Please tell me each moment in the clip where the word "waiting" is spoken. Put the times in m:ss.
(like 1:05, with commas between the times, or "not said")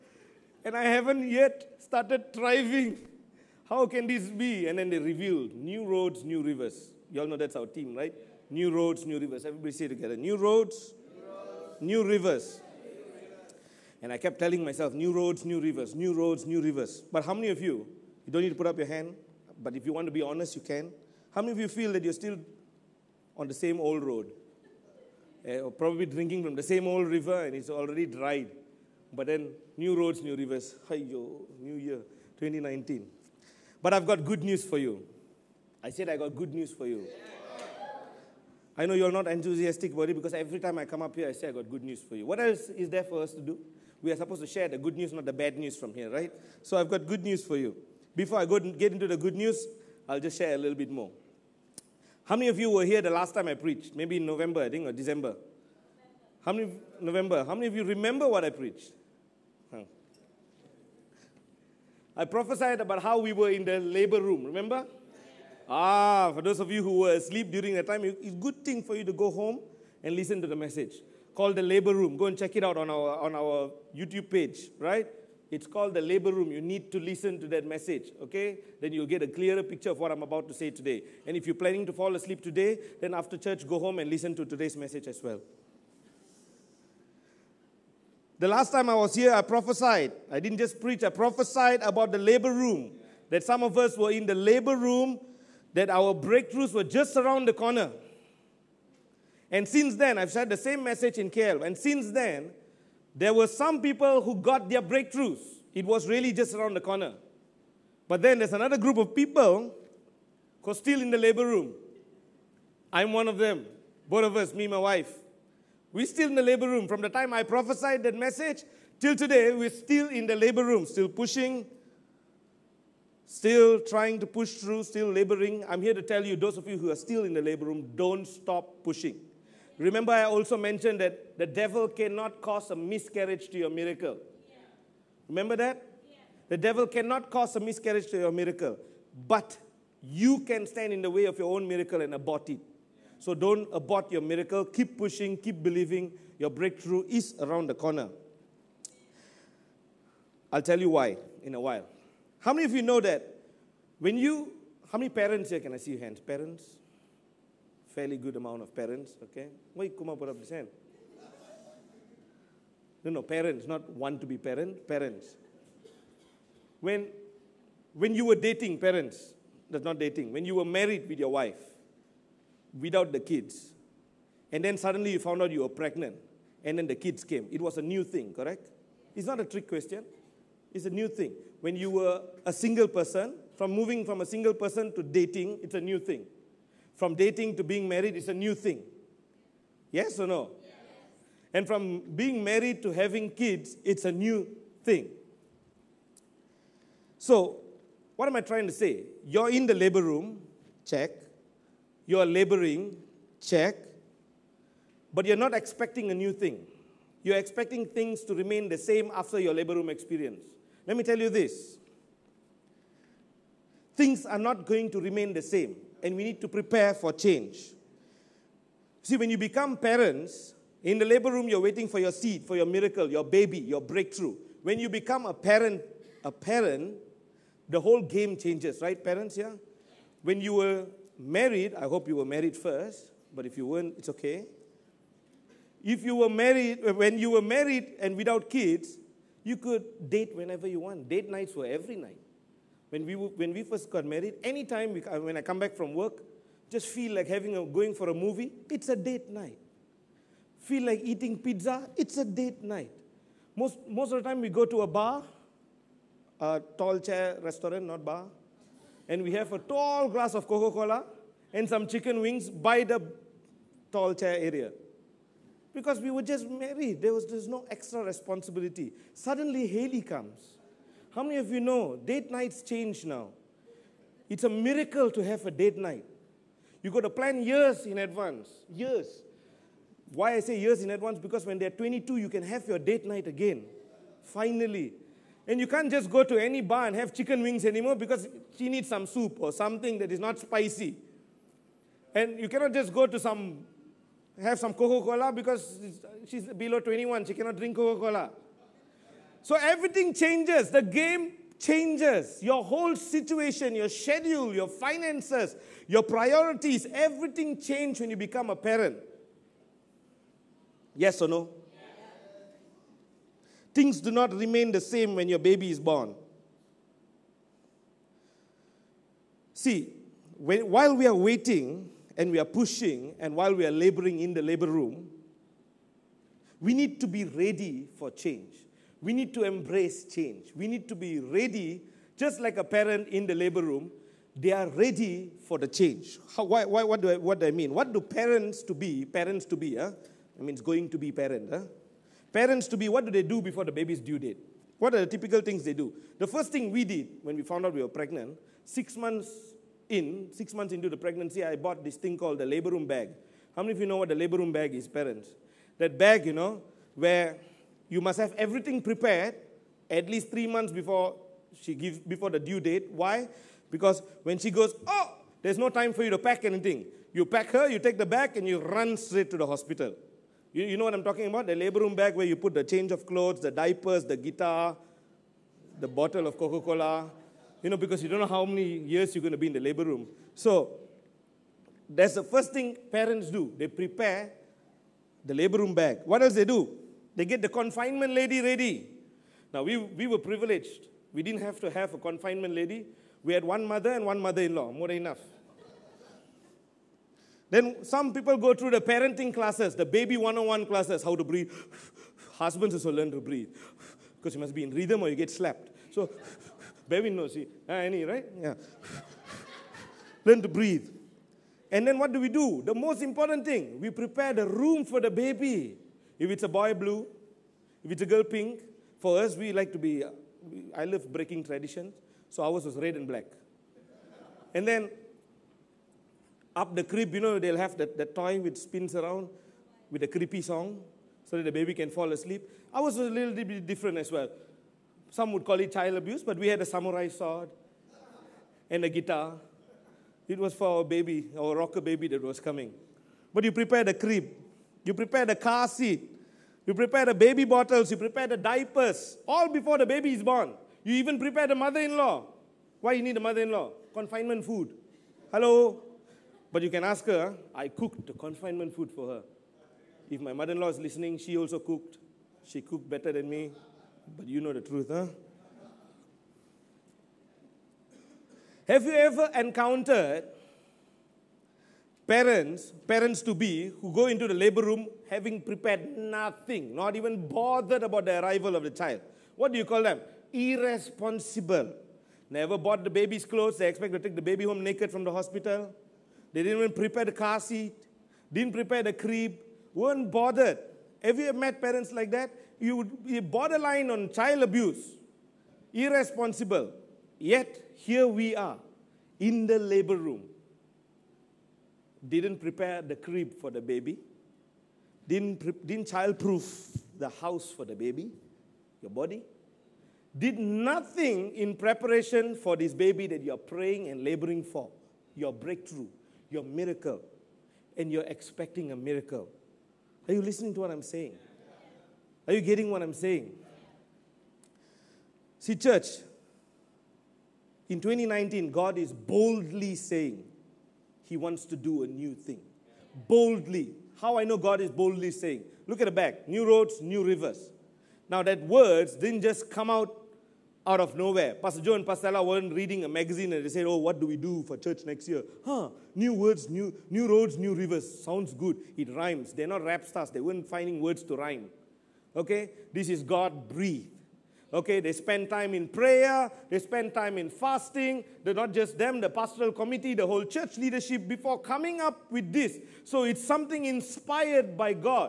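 3:41, 5:21.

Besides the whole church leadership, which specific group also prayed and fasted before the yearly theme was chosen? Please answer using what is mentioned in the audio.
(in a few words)
Pastoral committee.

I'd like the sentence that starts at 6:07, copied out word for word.
You pack her, you take the bag, and you run straight to the hospital.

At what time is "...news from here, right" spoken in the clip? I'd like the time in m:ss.
0:45.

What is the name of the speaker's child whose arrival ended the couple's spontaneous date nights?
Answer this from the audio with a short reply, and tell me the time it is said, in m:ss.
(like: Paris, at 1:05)
Haley, at 4:29.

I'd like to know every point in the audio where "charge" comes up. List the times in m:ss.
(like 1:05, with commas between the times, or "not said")
not said.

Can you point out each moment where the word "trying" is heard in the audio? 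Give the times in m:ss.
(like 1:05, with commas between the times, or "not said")
2:03, 3:18.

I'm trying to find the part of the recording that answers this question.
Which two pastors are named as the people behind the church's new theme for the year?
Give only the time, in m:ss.
9:01.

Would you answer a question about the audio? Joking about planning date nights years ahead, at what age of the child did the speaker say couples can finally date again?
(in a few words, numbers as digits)
22.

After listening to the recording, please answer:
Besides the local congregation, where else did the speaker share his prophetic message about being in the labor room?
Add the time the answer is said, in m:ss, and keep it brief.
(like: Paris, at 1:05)
KL, at 1:41.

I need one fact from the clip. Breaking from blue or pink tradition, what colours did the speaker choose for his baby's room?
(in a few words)
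Red and black.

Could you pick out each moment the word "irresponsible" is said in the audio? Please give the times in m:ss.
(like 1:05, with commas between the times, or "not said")
8:00, 8:15.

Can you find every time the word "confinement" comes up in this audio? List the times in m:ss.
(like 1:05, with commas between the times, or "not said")
6:27, 6:31, 7:33, 7:38.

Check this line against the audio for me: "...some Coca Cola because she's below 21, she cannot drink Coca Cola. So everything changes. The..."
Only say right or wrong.
right.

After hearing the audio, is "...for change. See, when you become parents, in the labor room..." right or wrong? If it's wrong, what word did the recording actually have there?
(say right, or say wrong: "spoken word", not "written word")
right.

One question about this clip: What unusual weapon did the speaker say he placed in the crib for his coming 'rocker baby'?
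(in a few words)
Samurai sword.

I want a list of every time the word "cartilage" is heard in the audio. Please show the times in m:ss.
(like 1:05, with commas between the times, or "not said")
not said.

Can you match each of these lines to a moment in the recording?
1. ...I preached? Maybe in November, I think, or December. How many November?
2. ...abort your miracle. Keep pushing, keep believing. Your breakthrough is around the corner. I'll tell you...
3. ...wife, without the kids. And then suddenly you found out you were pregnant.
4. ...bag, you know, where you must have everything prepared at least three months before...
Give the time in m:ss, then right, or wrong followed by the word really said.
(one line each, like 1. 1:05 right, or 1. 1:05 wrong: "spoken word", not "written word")
1. 0:53 right
2. 2:23 right
3. 2:51 right
4. 5:55 right.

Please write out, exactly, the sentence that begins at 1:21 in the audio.
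And if you're planning to fall asleep today, then after church, go home and listen to today's message as well.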